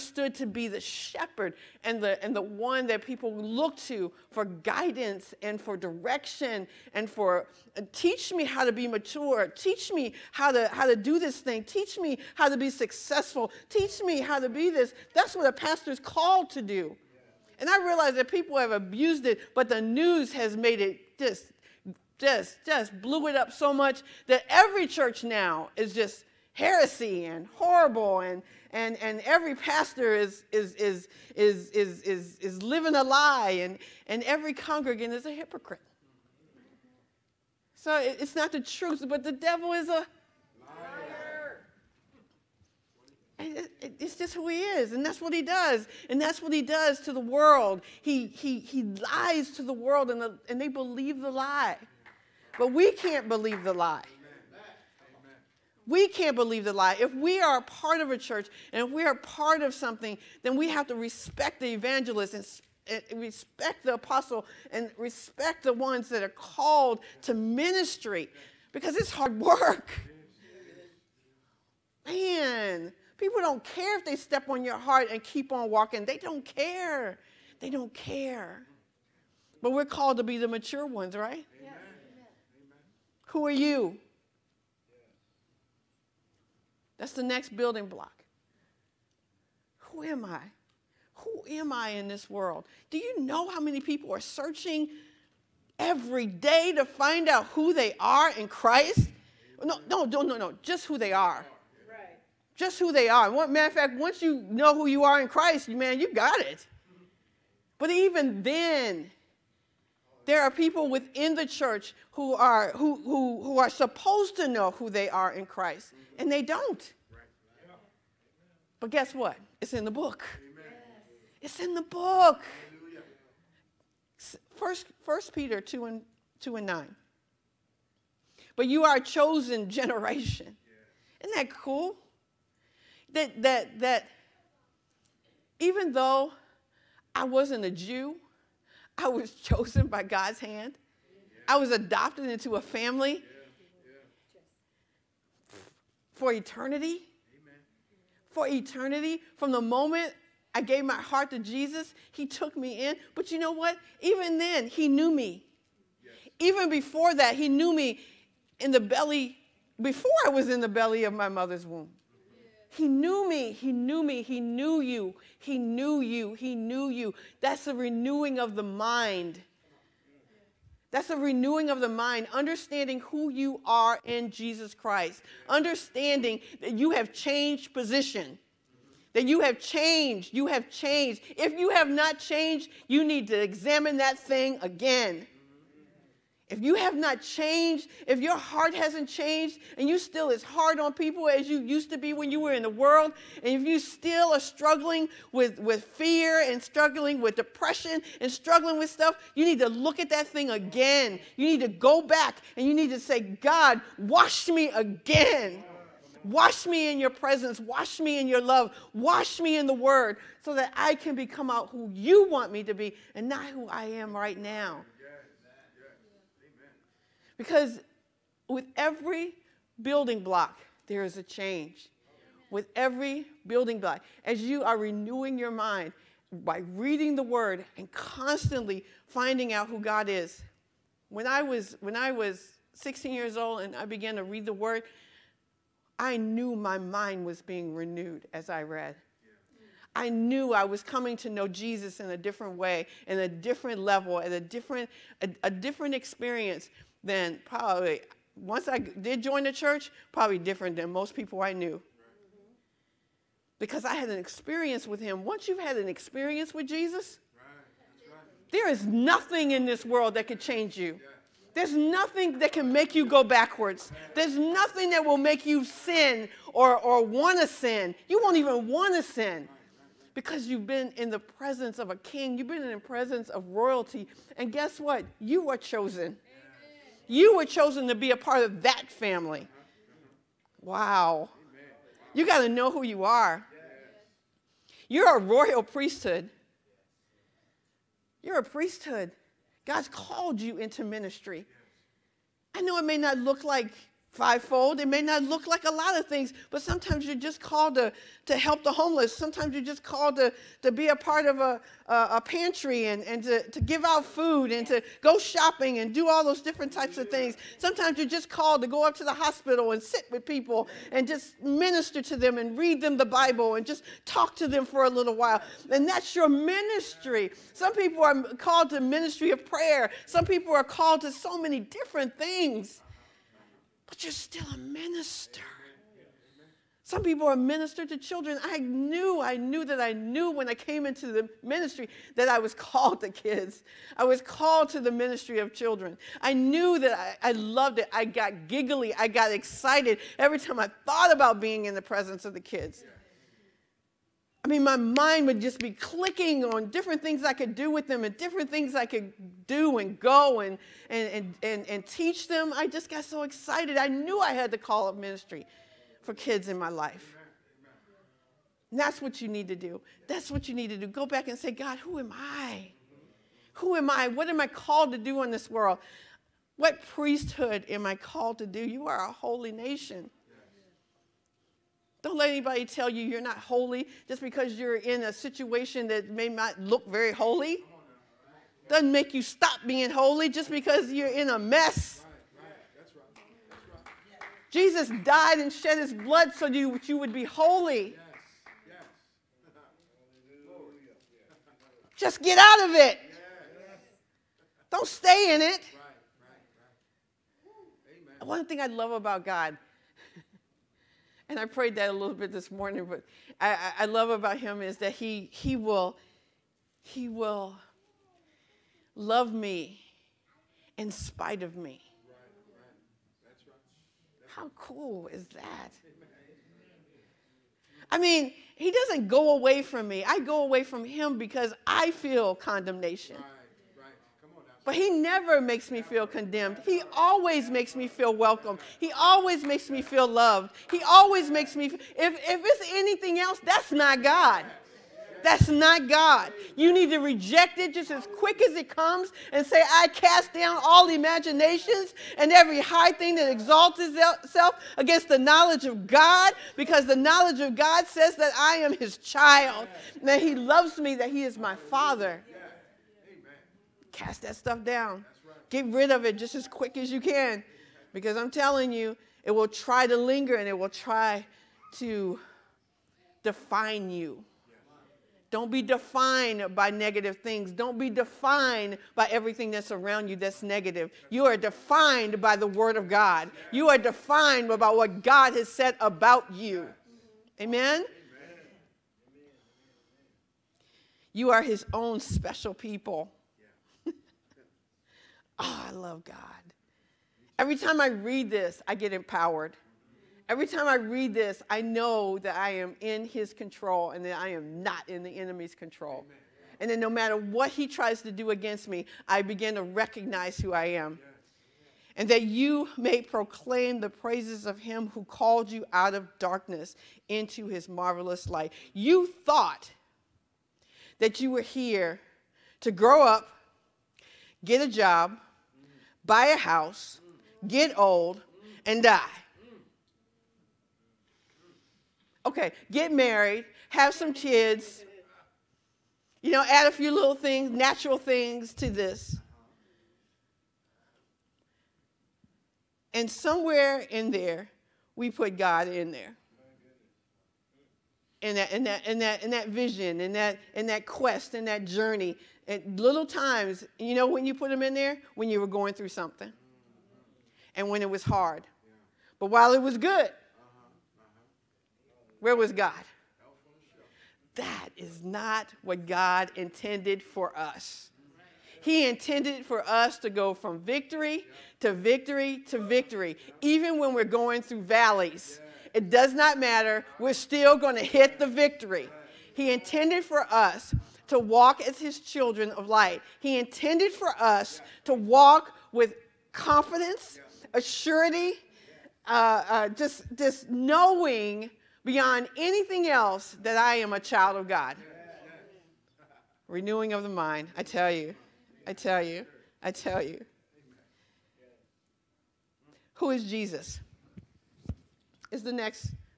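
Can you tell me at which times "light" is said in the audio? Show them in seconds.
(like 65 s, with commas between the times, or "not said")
508 s, 572 s.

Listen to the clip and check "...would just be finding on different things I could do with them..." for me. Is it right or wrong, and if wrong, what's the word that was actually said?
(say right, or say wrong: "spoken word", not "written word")
wrong: "clicking", not "finding".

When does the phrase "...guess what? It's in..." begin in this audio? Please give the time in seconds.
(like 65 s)
118 s.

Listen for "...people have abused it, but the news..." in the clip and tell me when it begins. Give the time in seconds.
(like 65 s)
18 s.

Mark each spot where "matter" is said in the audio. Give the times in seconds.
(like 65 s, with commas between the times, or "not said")
103 s, 496 s, 566 s.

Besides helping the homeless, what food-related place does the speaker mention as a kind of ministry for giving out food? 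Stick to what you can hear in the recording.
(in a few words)
a pantry.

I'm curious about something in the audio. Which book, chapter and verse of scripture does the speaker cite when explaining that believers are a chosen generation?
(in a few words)
First Peter 2:9.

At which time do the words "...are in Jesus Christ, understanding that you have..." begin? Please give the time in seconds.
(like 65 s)
173 s.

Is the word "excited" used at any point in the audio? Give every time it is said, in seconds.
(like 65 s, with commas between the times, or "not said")
339 s, 353 s.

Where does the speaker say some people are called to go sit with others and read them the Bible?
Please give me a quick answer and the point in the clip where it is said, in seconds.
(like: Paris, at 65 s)
the hospital, at 309 s.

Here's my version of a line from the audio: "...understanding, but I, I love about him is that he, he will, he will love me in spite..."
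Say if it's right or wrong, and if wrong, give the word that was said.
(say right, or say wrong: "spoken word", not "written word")
wrong: "morning", not "understanding".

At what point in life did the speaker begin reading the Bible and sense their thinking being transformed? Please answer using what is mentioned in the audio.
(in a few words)
16 years old.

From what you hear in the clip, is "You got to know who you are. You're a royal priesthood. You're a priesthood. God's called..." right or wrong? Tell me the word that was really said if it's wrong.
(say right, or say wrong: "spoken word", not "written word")
right.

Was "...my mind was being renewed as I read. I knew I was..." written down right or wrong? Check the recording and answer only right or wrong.
right.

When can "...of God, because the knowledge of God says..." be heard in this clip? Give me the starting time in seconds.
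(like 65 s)
445 s.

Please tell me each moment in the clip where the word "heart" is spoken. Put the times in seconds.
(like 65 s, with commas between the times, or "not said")
74 s, 151 s, 188 s.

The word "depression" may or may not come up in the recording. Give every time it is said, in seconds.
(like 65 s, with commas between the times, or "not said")
197 s.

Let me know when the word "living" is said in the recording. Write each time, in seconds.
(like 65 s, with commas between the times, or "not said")
32 s.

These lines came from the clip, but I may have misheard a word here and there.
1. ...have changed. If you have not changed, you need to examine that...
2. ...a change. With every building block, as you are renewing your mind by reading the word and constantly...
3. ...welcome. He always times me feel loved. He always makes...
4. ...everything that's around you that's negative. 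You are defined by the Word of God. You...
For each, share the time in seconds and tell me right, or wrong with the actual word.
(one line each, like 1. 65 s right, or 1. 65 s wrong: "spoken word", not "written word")
1. 180 s right
2. 221 s right
3. 428 s wrong: "makes", not "times"
4. 469 s right.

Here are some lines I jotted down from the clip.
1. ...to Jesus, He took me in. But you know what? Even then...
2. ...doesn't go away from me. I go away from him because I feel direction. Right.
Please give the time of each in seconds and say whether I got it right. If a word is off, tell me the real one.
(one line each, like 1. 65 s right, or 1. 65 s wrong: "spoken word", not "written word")
1. 151 s right
2. 418 s wrong: "condemnation", not "direction".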